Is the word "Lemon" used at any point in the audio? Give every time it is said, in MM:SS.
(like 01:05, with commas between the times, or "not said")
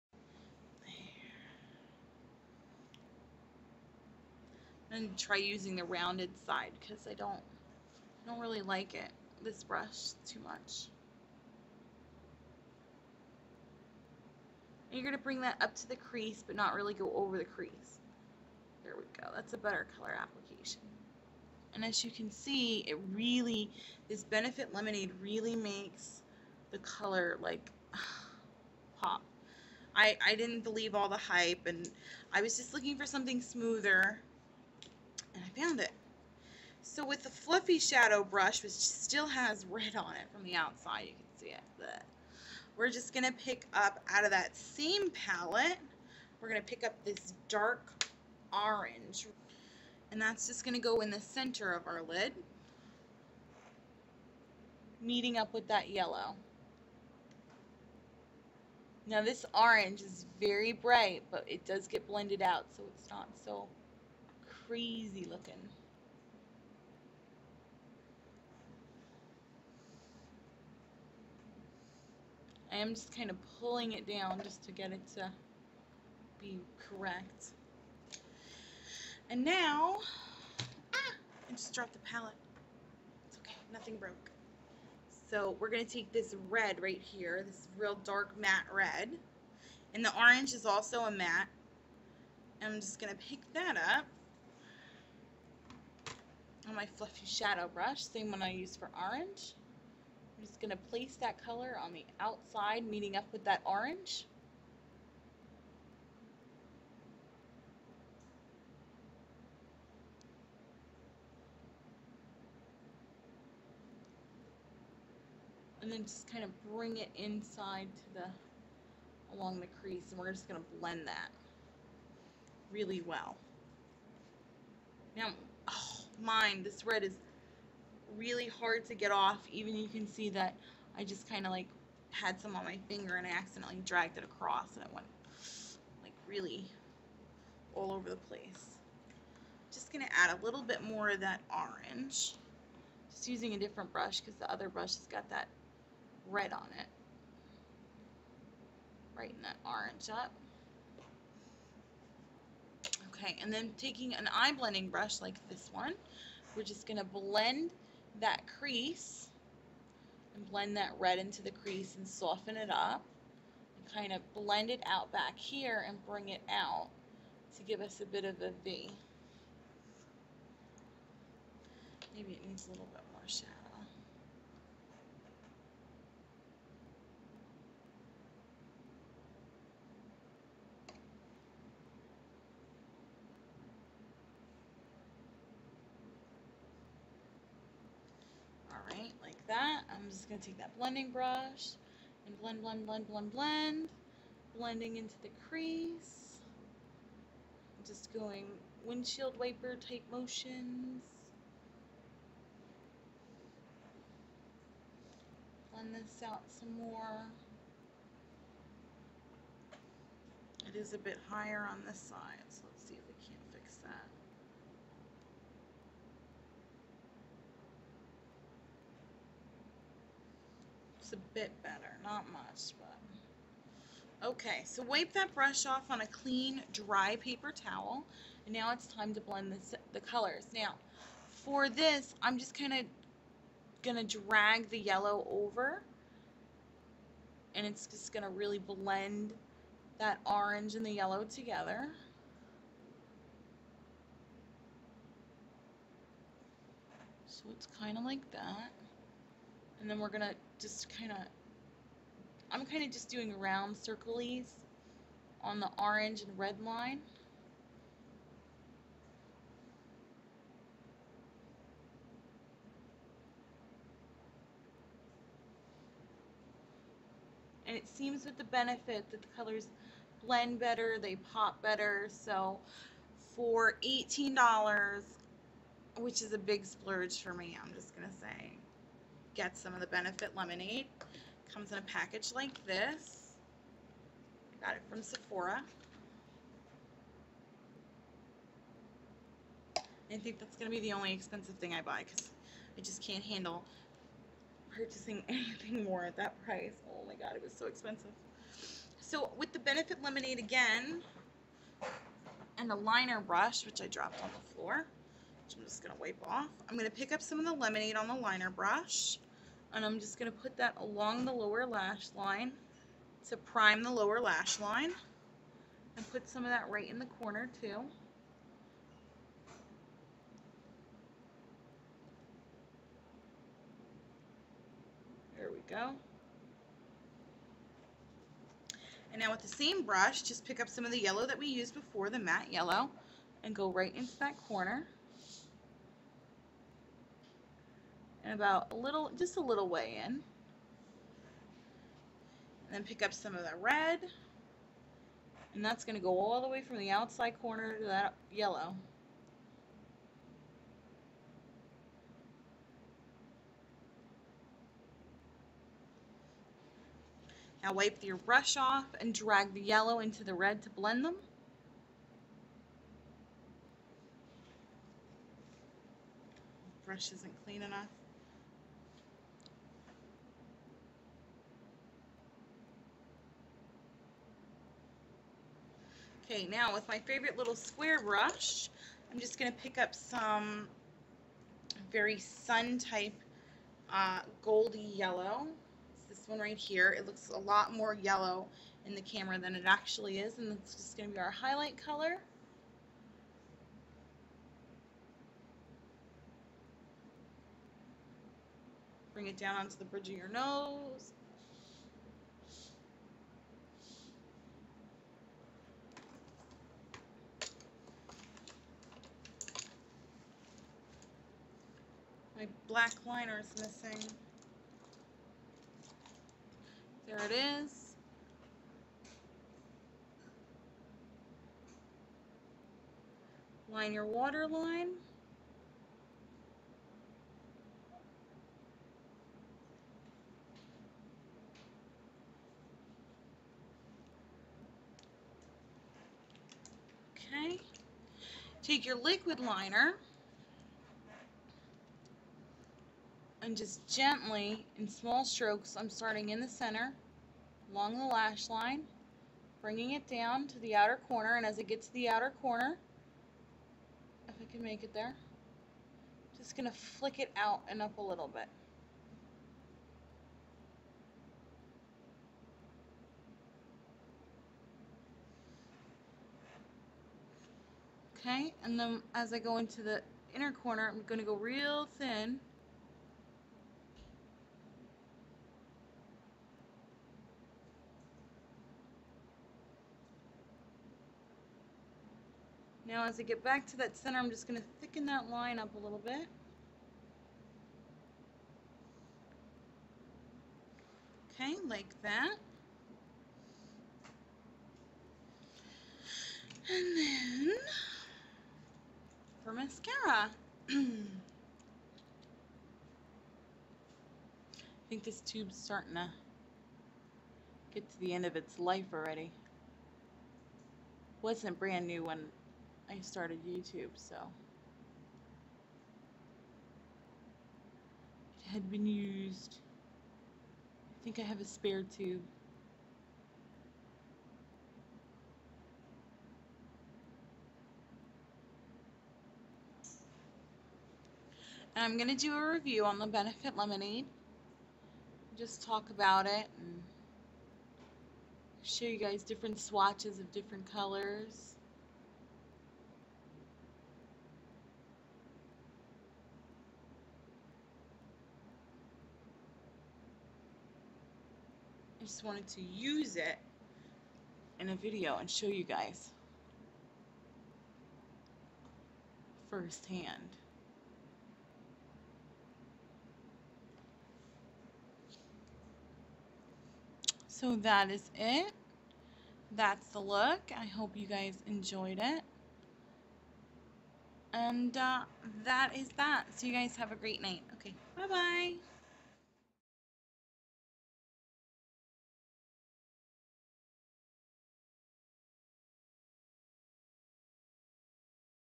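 00:24, 04:40, 05:00, 05:07, 08:53.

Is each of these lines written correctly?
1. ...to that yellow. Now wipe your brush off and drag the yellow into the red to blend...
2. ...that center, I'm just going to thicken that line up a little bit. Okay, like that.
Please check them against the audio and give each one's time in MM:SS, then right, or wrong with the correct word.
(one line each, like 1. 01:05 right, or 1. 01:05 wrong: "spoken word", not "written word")
1. 05:47 right
2. 08:03 right.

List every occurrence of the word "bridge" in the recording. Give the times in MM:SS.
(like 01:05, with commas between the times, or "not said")
06:39.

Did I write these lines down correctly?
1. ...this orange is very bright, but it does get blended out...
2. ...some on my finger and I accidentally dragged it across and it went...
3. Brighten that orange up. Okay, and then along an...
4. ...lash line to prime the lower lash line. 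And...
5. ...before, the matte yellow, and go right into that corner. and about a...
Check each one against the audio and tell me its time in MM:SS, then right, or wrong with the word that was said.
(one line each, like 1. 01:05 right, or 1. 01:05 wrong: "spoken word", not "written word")
1. 00:59 right
2. 02:12 right
3. 02:29 wrong: "taking", not "along"
4. 05:11 right
5. 05:31 right.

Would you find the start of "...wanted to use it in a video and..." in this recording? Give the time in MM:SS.
09:12.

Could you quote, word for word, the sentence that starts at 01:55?
And then just kind of bring it inside to the, along the crease, and we're just going to blend that really well.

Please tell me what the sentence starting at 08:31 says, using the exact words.
Wasn't brand new when I started YouTube, so it had been used.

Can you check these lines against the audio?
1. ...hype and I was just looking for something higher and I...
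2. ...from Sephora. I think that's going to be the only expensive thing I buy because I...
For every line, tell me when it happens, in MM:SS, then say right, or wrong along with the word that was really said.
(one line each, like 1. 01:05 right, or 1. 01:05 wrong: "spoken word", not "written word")
1. 00:31 wrong: "smoother", not "higher"
2. 04:44 right.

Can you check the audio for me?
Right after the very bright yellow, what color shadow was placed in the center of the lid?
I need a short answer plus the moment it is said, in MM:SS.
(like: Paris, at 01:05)
dark orange, at 00:47.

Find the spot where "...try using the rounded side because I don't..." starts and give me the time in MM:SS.
00:05.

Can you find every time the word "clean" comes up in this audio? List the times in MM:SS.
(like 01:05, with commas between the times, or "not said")
03:46, 06:07.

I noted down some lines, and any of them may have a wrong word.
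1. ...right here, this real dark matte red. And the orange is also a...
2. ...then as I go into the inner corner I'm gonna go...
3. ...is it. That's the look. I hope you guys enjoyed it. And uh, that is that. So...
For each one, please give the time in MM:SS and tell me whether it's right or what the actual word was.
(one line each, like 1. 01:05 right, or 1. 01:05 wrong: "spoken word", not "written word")
1. 01:26 right
2. 07:48 right
3. 09:27 right.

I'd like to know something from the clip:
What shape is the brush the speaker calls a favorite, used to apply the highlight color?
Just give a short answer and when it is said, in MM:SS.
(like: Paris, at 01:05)
square, at 06:17.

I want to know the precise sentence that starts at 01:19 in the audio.
And now, ah, I just dropped the palette.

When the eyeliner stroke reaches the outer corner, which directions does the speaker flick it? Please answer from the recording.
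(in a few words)
out and up.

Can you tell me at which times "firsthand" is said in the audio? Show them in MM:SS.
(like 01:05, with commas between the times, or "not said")
09:19.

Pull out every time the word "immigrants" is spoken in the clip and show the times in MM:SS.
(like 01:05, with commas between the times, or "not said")
not said.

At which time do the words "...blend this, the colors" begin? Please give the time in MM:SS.
03:49.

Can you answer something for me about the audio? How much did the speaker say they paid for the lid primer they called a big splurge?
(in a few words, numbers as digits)
$18.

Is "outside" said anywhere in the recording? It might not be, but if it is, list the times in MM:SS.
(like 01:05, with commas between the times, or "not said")
00:40, 01:42, 05:46.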